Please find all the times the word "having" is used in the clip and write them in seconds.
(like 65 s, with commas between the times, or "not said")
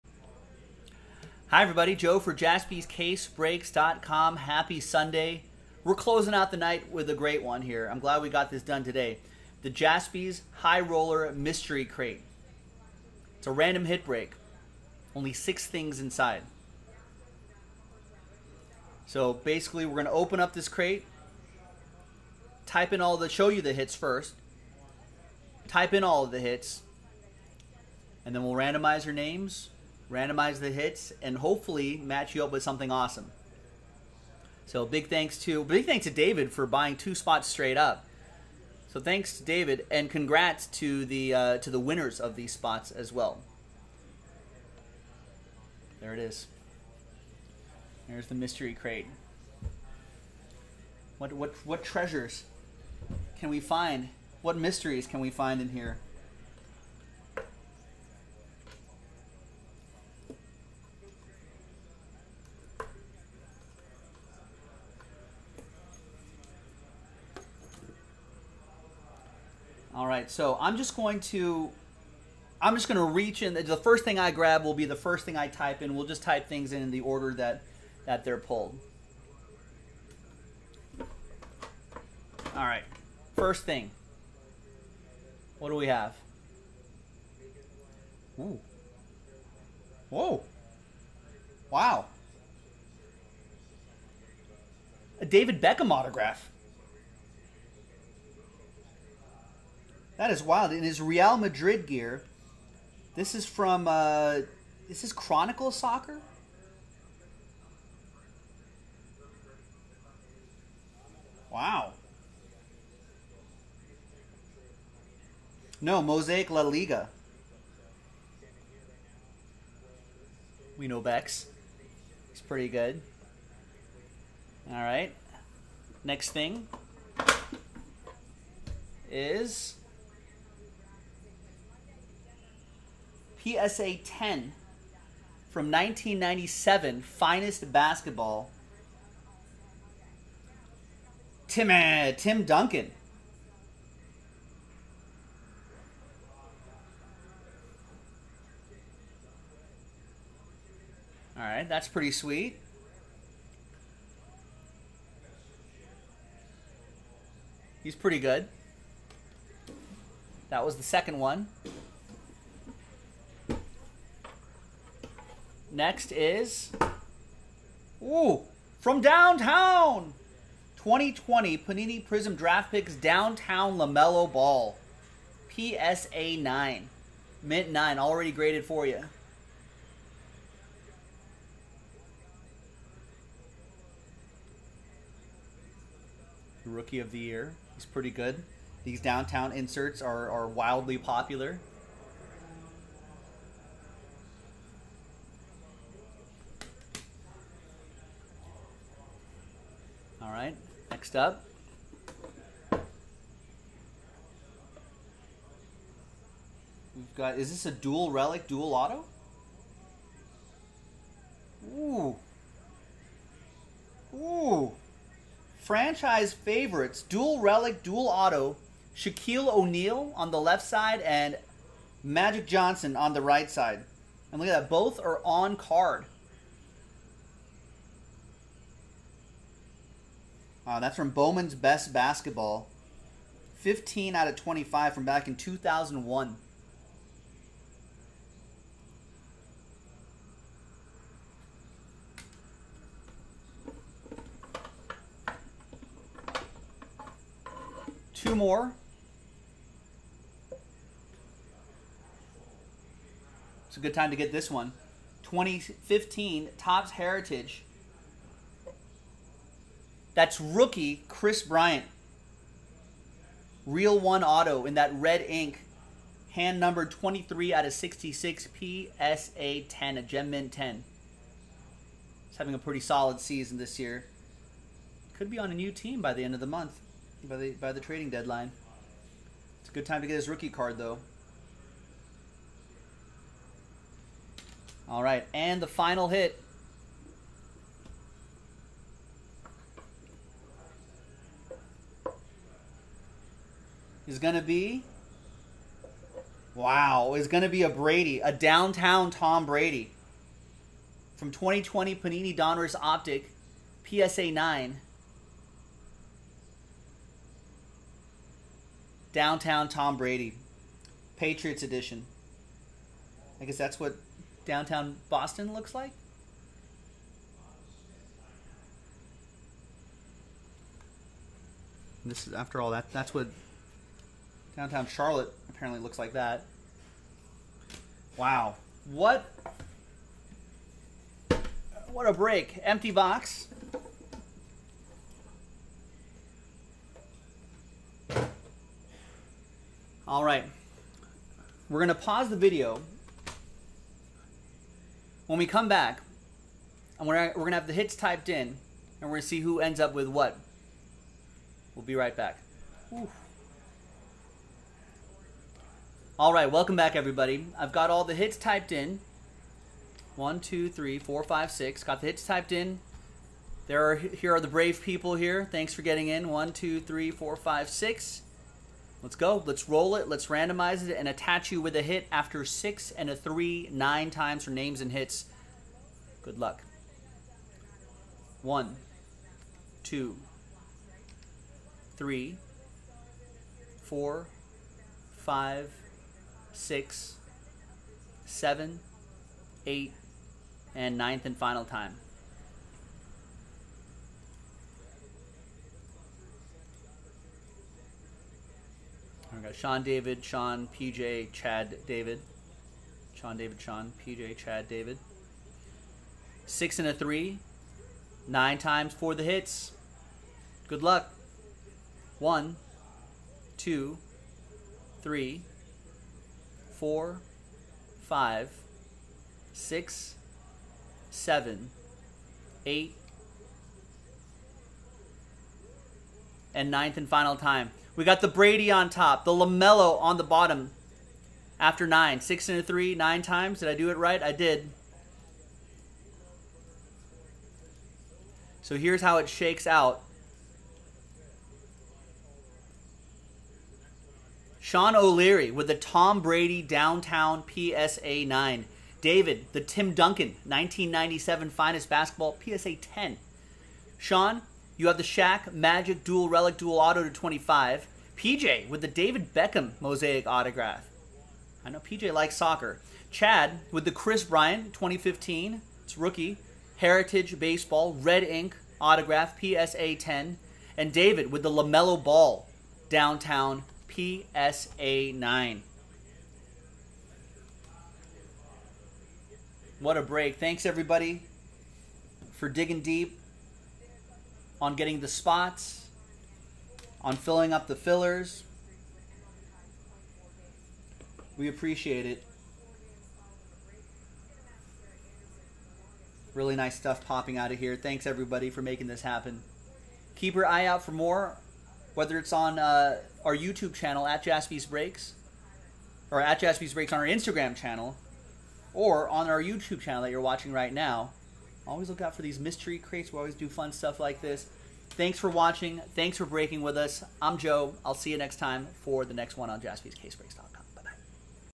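272 s.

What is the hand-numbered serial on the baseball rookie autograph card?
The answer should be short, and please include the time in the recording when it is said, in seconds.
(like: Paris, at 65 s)
23 out of 66, at 266 s.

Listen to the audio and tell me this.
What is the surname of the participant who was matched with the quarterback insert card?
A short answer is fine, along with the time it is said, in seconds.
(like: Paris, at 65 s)
O'Leary, at 444 s.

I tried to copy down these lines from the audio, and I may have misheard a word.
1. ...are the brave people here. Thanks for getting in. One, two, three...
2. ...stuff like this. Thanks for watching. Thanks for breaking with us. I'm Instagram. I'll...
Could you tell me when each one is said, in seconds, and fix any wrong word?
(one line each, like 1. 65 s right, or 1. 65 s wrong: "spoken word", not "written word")
1. 364 s right
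2. 513 s wrong: "Joe", not "Instagram".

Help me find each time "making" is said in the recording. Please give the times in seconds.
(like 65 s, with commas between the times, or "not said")
498 s.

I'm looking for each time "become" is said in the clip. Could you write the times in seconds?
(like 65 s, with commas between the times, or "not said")
not said.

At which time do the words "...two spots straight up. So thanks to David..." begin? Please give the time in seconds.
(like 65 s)
36 s.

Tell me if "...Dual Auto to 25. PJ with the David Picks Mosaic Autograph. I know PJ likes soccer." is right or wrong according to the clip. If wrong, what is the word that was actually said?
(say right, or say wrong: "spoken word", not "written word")
wrong: "Beckham", not "Picks".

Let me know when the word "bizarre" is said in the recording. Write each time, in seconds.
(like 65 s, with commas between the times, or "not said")
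not said.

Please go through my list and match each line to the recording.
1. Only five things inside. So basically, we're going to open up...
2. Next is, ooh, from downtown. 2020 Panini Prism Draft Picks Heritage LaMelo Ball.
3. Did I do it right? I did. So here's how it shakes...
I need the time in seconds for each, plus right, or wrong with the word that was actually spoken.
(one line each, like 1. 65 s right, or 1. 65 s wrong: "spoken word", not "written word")
1. 15 s wrong: "six", not "five"
2. 165 s wrong: "Downtown", not "Heritage"
3. 433 s right.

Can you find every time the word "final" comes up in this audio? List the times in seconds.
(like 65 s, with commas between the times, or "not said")
285 s, 391 s, 427 s.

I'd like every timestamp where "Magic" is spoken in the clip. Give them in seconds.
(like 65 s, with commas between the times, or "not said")
222 s, 455 s.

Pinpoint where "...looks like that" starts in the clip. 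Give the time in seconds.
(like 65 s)
325 s.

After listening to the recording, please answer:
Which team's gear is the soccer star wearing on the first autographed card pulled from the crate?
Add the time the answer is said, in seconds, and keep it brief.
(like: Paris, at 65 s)
Real Madrid, at 101 s.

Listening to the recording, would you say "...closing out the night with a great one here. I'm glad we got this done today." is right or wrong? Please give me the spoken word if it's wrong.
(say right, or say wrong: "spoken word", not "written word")
right.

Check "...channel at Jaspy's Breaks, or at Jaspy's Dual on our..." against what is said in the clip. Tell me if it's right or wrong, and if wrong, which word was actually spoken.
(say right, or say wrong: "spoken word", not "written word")
wrong: "Breaks", not "Dual".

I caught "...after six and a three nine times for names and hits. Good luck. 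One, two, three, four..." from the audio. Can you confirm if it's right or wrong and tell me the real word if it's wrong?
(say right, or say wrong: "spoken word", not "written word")
right.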